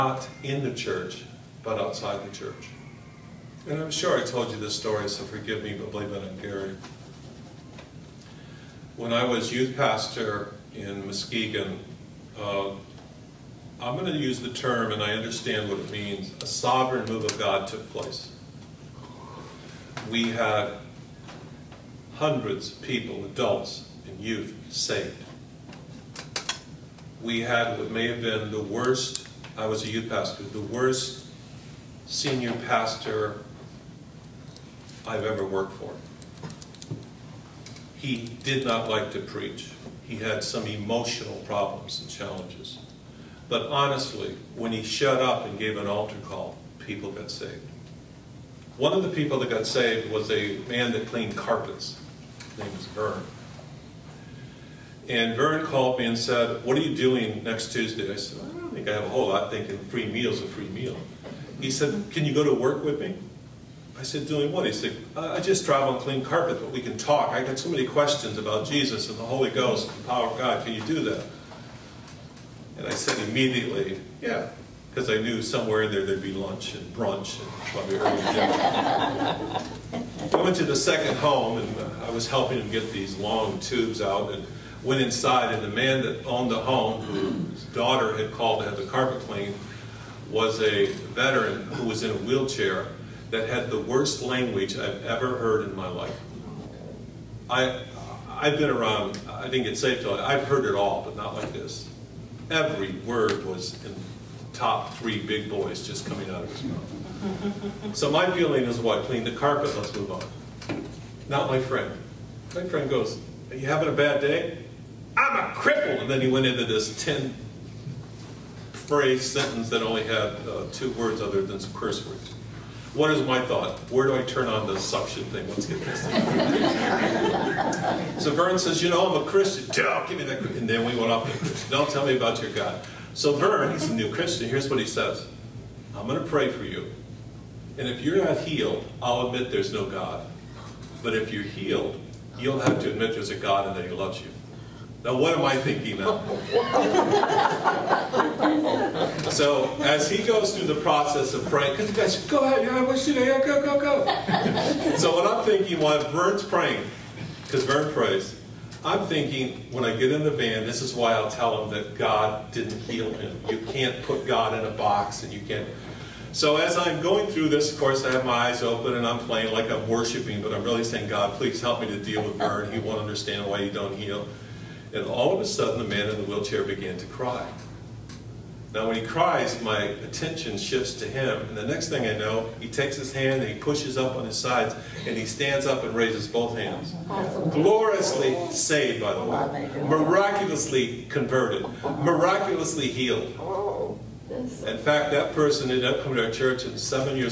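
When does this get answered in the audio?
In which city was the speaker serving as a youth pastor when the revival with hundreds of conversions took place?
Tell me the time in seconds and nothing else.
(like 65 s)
11 s.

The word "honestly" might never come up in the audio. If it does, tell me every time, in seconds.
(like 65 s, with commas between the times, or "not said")
43 s.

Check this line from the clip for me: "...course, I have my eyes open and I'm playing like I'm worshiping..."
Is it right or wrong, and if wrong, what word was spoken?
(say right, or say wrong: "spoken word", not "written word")
right.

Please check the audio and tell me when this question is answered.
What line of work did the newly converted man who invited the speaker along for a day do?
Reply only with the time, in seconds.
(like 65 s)
51 s.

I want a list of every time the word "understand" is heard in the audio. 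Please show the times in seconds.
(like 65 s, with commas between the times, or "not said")
15 s, 173 s.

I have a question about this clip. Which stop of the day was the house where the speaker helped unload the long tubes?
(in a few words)
Second.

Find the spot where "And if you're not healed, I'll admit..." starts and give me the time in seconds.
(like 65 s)
137 s.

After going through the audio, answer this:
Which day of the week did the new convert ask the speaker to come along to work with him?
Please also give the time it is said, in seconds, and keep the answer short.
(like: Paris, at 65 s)
Tuesday, at 57 s.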